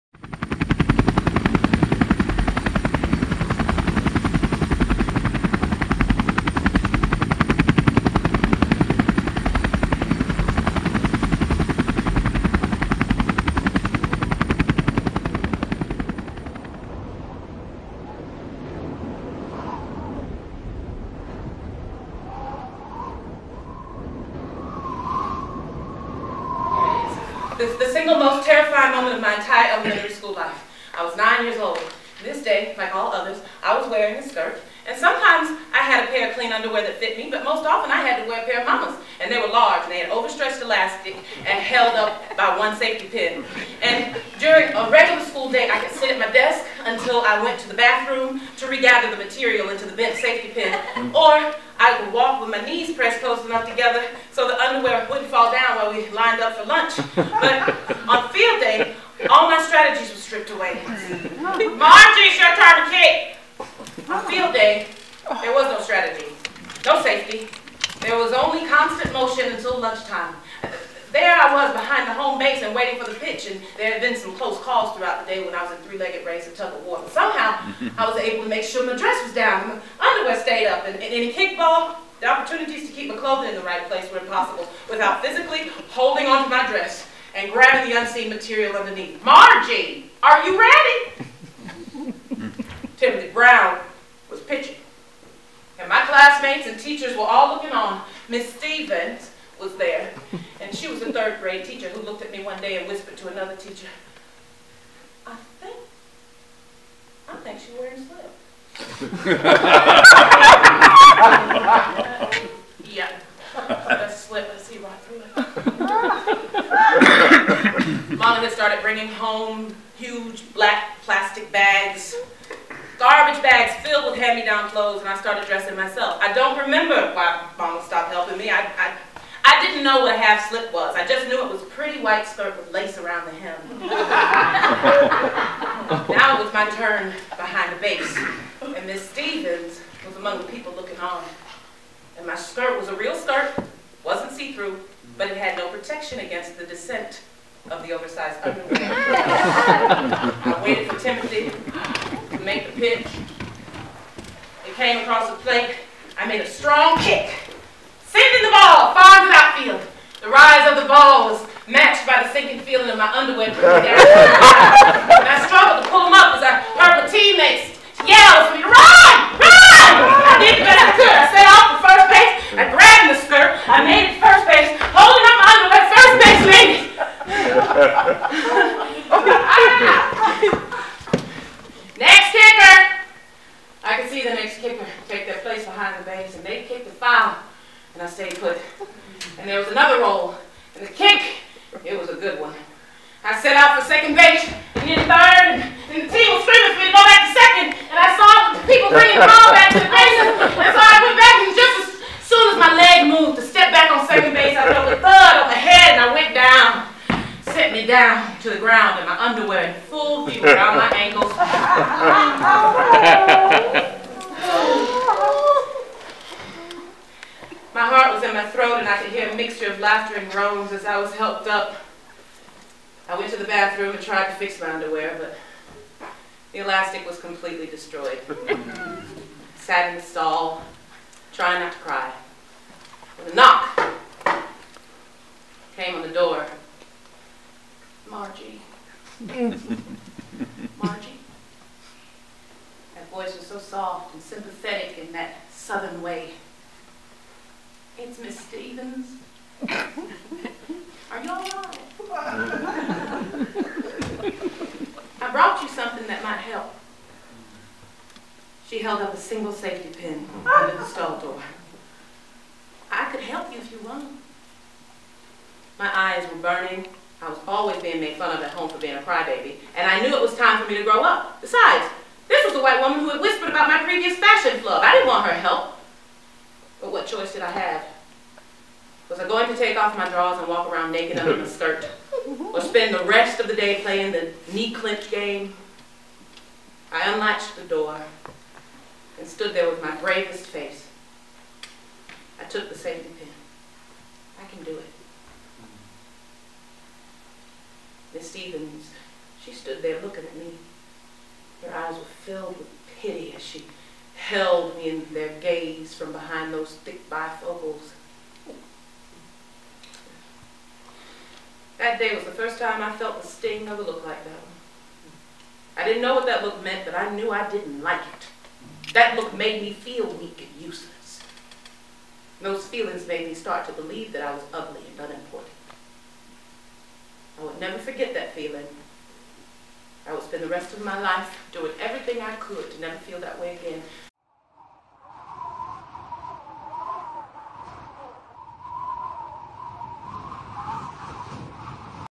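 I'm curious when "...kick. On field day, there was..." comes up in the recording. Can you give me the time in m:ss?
1:02.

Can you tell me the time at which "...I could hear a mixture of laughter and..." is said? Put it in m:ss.
3:38.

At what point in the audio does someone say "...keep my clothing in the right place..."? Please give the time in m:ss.
1:22.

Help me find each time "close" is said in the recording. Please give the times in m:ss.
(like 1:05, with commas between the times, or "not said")
0:53, 1:14.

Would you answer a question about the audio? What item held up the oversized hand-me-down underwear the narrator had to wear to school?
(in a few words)
one safety pin.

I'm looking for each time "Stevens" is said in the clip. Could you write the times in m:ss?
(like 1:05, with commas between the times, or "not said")
1:38, 2:19, 4:08, 4:58.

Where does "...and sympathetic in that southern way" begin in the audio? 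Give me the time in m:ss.
4:04.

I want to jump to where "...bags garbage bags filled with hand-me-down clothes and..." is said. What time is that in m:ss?
2:01.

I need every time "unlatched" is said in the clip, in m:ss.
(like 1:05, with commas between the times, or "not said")
4:47.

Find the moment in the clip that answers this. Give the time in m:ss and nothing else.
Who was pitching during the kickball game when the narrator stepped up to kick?
1:32.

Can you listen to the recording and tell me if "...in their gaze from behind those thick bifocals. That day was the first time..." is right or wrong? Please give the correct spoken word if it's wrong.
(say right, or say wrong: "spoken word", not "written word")
right.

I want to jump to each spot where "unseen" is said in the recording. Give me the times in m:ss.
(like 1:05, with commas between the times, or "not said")
1:27.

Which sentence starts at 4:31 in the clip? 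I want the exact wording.
Besides, this was the white woman who had whispered about my previous fashion flub.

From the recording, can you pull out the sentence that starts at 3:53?
When a knock came on the door.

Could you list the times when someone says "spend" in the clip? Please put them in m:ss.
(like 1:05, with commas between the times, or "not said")
4:42, 5:30.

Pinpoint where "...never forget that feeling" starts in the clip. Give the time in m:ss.
5:27.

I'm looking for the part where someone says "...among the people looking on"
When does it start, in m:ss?
2:20.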